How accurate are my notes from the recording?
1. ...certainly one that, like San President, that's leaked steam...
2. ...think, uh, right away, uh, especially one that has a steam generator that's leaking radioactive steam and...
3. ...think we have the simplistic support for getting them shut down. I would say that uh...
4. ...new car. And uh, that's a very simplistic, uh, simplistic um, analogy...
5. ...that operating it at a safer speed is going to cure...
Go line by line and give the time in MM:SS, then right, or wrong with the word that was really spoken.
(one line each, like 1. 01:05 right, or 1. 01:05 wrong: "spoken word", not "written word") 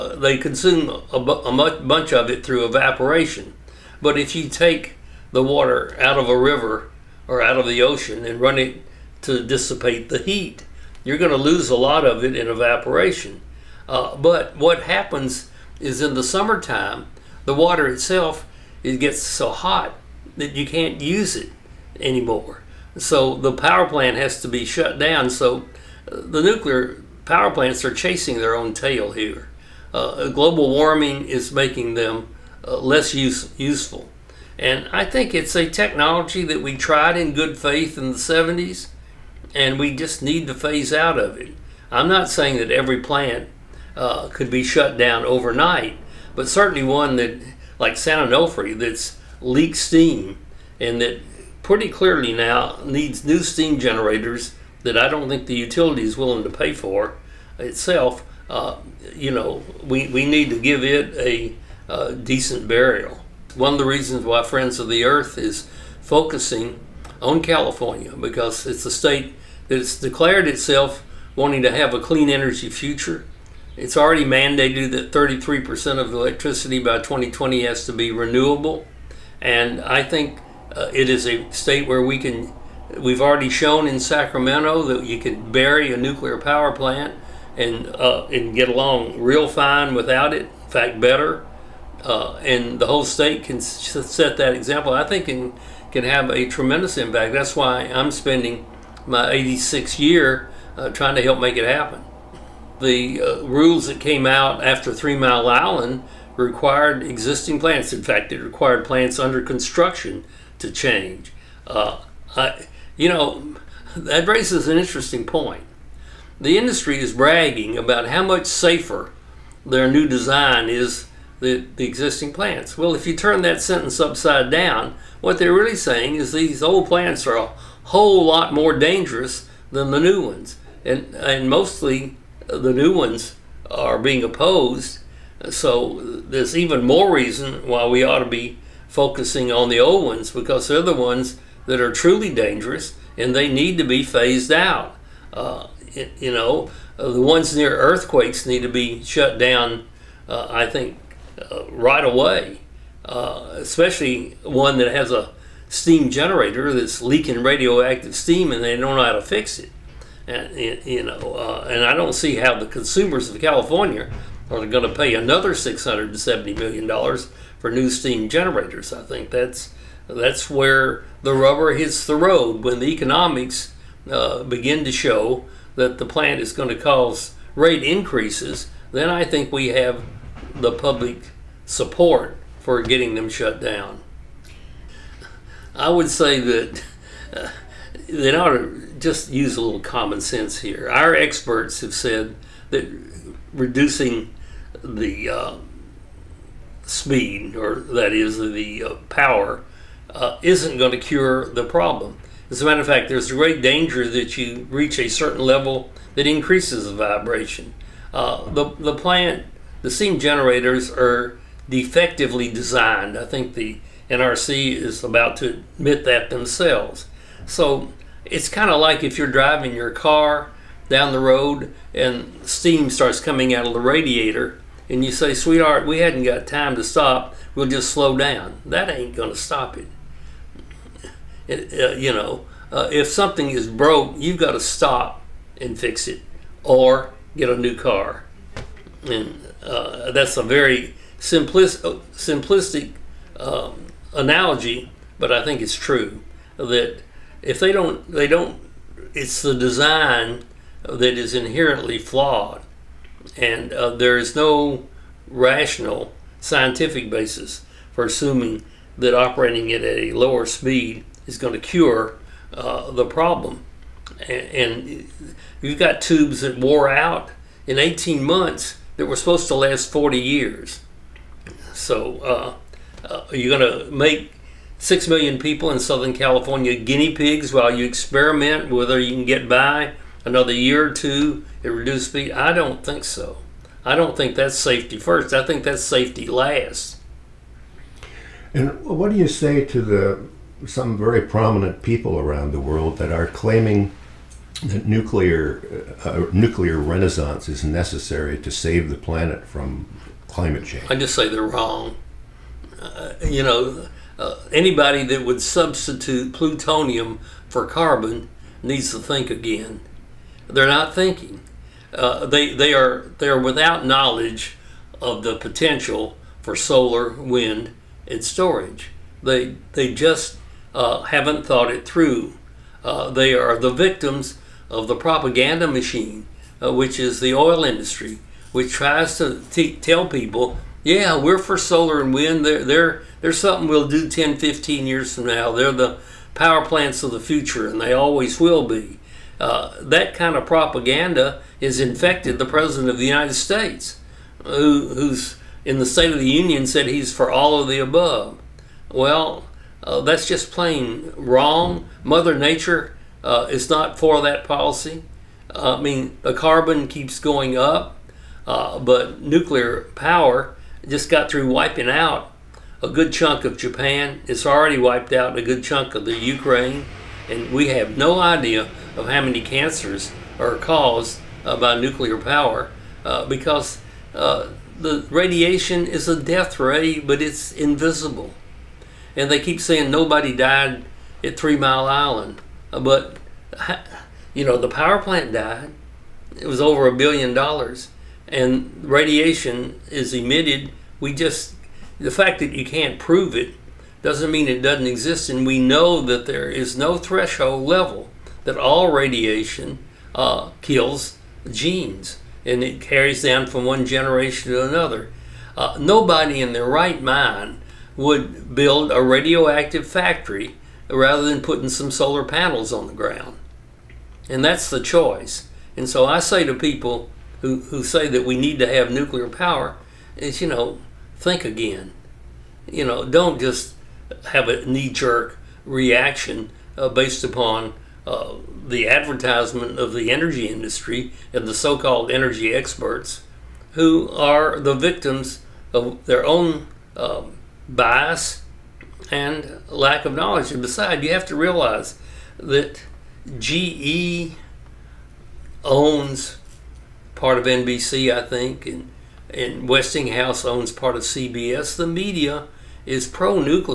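1. 00:46 wrong: "Onofre", not "President"
2. 02:30 right
3. 02:59 wrong: "public", not "simplistic"
4. 03:57 right
5. 04:18 wrong: "lower", not "safer".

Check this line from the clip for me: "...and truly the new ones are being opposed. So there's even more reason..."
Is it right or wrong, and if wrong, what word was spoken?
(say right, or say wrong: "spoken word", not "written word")
wrong: "mostly", not "truly".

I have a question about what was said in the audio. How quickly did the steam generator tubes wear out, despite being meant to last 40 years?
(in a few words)
18 months.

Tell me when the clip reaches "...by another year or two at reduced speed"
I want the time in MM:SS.
04:39.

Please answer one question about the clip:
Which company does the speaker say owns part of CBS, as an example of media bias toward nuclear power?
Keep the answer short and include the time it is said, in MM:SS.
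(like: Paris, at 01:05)
Westinghouse, at 07:29.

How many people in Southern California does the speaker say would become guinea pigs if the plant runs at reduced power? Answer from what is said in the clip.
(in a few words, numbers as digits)
6 million.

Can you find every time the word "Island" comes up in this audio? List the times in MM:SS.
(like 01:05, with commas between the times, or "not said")
01:45, 06:21.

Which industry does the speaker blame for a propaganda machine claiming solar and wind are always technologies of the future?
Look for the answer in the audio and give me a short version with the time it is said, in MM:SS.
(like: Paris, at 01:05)
The oil industry, at 05:27.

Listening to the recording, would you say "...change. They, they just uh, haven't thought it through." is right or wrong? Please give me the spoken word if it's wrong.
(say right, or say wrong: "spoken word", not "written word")
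wrong: "storage", not "change".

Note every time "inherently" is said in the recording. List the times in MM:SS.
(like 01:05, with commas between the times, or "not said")
04:11.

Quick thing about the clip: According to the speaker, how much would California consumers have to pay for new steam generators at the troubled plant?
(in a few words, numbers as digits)
$670 million.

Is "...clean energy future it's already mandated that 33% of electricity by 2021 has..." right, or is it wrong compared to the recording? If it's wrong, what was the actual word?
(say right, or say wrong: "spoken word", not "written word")
wrong: "2020", not "2021".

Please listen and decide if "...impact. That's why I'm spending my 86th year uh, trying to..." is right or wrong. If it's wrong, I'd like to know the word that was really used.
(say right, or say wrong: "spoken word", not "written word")
right.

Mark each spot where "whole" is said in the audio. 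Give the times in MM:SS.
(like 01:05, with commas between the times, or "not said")
01:32, 02:07.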